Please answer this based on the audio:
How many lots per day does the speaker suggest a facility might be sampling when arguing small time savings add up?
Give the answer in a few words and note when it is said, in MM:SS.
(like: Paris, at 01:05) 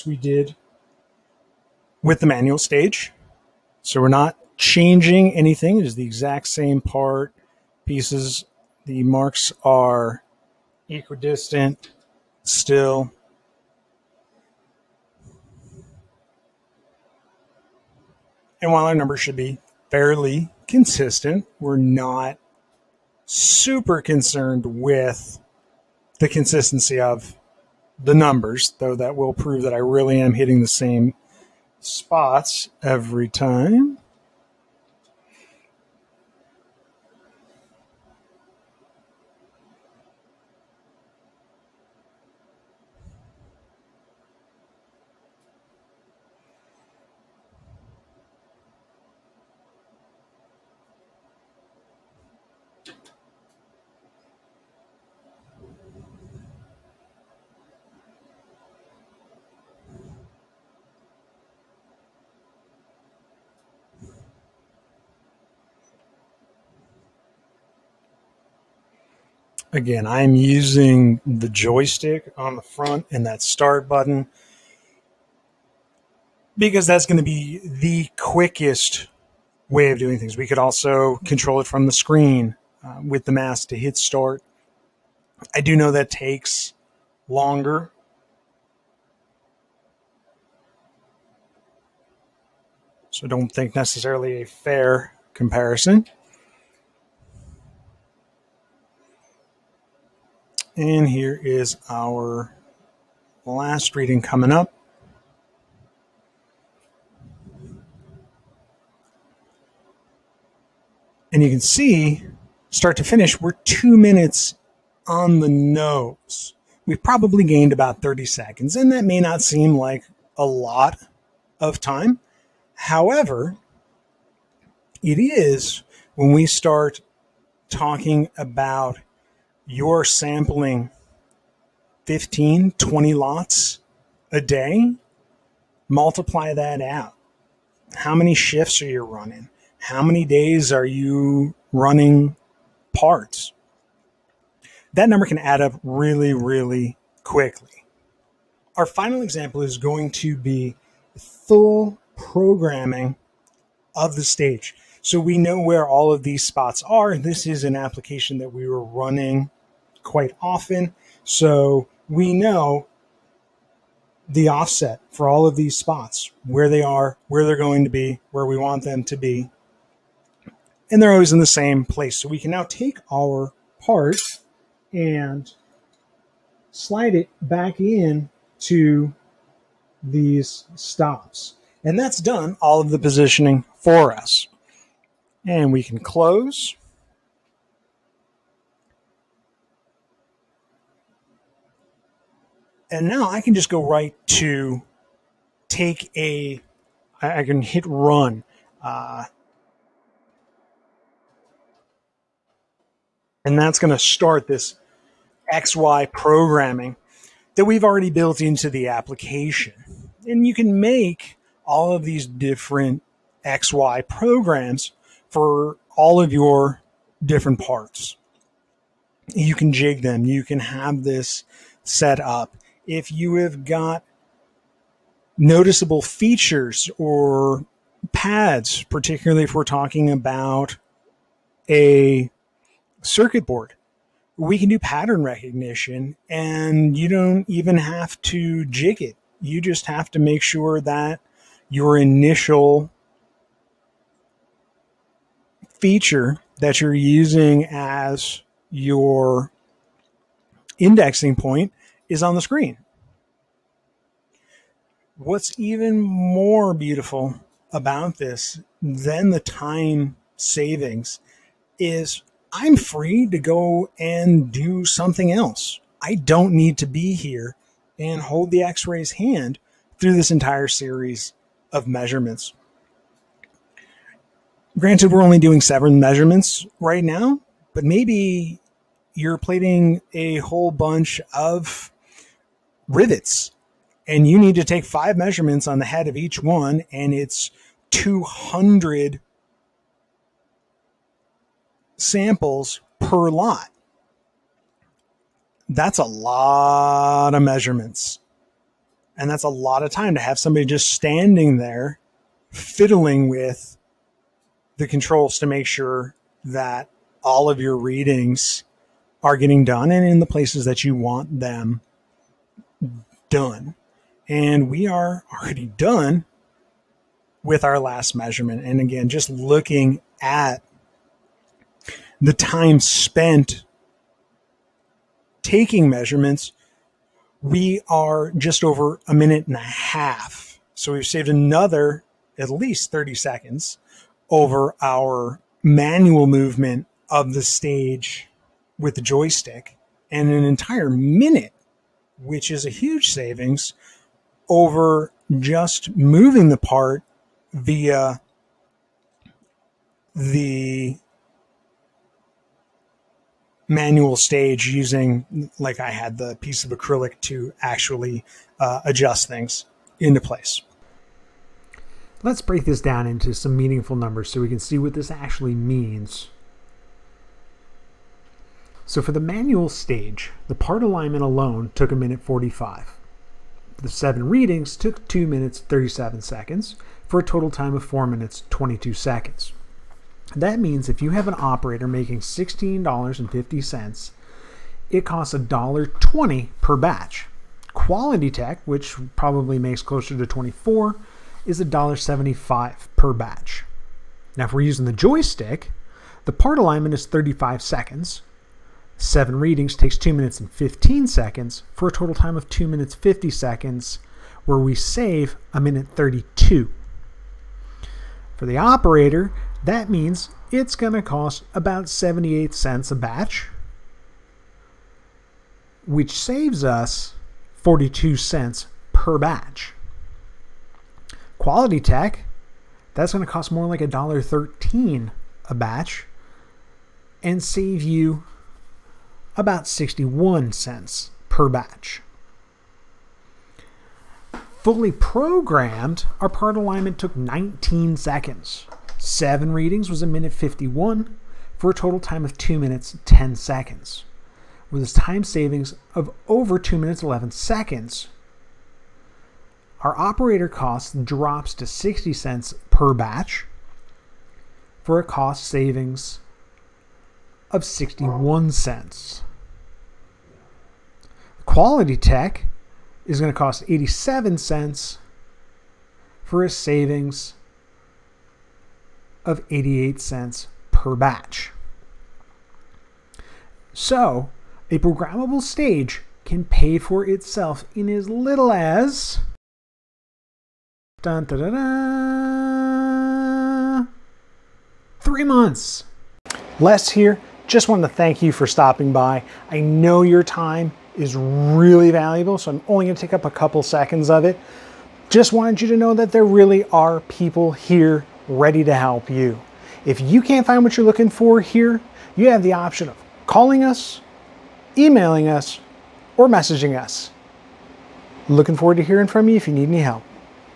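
15, 20, at 02:12.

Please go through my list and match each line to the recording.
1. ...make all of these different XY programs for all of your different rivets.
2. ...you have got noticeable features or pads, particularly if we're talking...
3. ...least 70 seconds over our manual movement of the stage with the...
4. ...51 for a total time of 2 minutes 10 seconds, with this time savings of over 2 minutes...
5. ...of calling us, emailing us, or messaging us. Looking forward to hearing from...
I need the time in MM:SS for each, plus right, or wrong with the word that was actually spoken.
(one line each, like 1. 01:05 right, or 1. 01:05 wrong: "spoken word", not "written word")
1. 03:30 wrong: "parts", not "rivets"
2. 03:43 right
3. 05:32 wrong: "30", not "70"
4. 07:20 right
5. 08:22 right.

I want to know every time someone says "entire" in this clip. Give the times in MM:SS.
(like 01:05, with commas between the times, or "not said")
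04:30, 05:40.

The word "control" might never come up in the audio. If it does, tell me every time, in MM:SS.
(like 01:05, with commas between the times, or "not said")
01:21, 05:04.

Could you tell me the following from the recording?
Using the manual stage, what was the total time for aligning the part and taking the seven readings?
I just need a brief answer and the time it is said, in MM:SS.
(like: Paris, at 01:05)
4 minutes 22 seconds, at 06:17.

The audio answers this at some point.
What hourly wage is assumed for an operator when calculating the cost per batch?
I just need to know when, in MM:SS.
06:22.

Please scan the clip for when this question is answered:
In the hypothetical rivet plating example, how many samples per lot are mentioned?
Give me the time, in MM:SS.
04:47.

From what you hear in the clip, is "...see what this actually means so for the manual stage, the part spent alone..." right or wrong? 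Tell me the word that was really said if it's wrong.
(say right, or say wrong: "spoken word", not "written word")
wrong: "alignment", not "spent".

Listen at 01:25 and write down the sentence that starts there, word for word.
I do know that takes longer.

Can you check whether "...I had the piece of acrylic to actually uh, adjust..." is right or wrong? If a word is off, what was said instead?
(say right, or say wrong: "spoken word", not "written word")
right.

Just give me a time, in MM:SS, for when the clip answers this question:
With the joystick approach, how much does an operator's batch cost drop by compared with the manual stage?
06:57.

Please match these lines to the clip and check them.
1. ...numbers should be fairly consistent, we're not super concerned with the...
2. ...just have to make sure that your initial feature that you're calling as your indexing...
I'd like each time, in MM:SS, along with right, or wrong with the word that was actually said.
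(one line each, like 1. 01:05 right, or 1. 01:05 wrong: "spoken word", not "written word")
1. 00:18 right
2. 03:59 wrong: "using", not "calling".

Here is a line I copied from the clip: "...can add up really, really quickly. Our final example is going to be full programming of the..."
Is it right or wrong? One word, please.
right.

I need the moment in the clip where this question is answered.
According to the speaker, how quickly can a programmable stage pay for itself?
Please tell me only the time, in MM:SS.
08:05.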